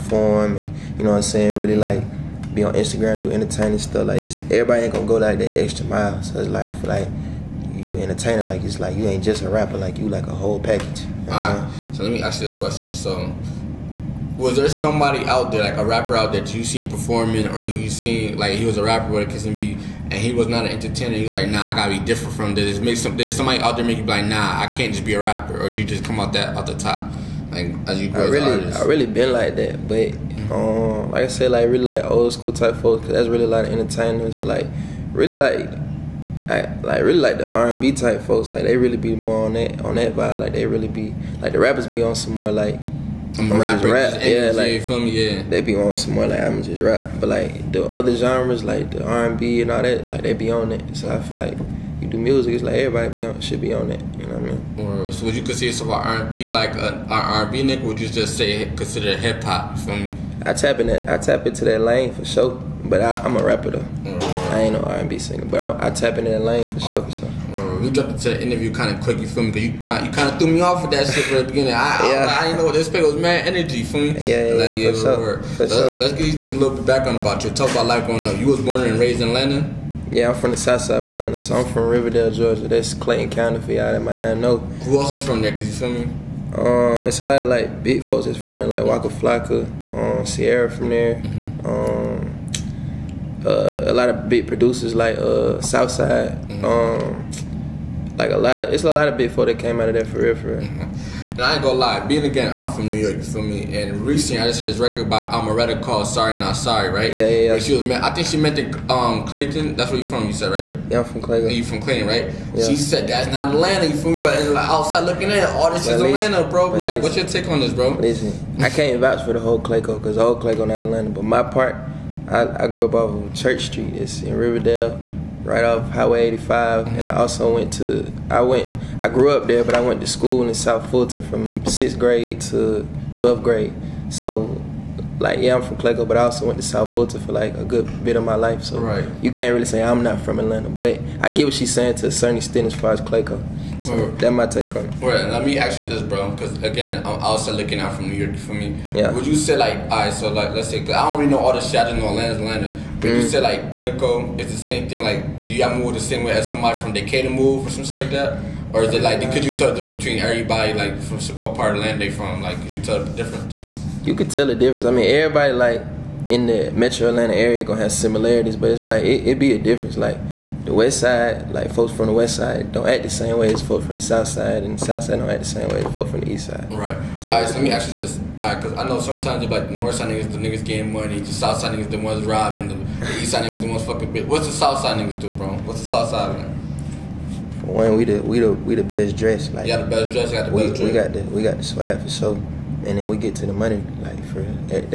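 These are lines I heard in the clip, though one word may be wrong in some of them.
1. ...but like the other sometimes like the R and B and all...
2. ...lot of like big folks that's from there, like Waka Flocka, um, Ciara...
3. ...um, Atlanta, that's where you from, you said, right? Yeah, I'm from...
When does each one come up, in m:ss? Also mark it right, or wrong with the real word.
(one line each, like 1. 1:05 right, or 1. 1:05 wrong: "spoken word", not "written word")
1. 0:47 wrong: "genres", not "sometimes"
2. 1:27 right
3. 1:48 wrong: "Clayton", not "Atlanta".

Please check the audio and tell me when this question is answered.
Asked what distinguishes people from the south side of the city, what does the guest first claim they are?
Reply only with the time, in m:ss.
3:08.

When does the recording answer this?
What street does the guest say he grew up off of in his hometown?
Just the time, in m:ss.
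2:03.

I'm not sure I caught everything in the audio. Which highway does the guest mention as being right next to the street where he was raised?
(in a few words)
Highway 85.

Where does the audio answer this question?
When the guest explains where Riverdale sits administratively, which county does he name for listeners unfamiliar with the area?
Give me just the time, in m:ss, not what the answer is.
1:22.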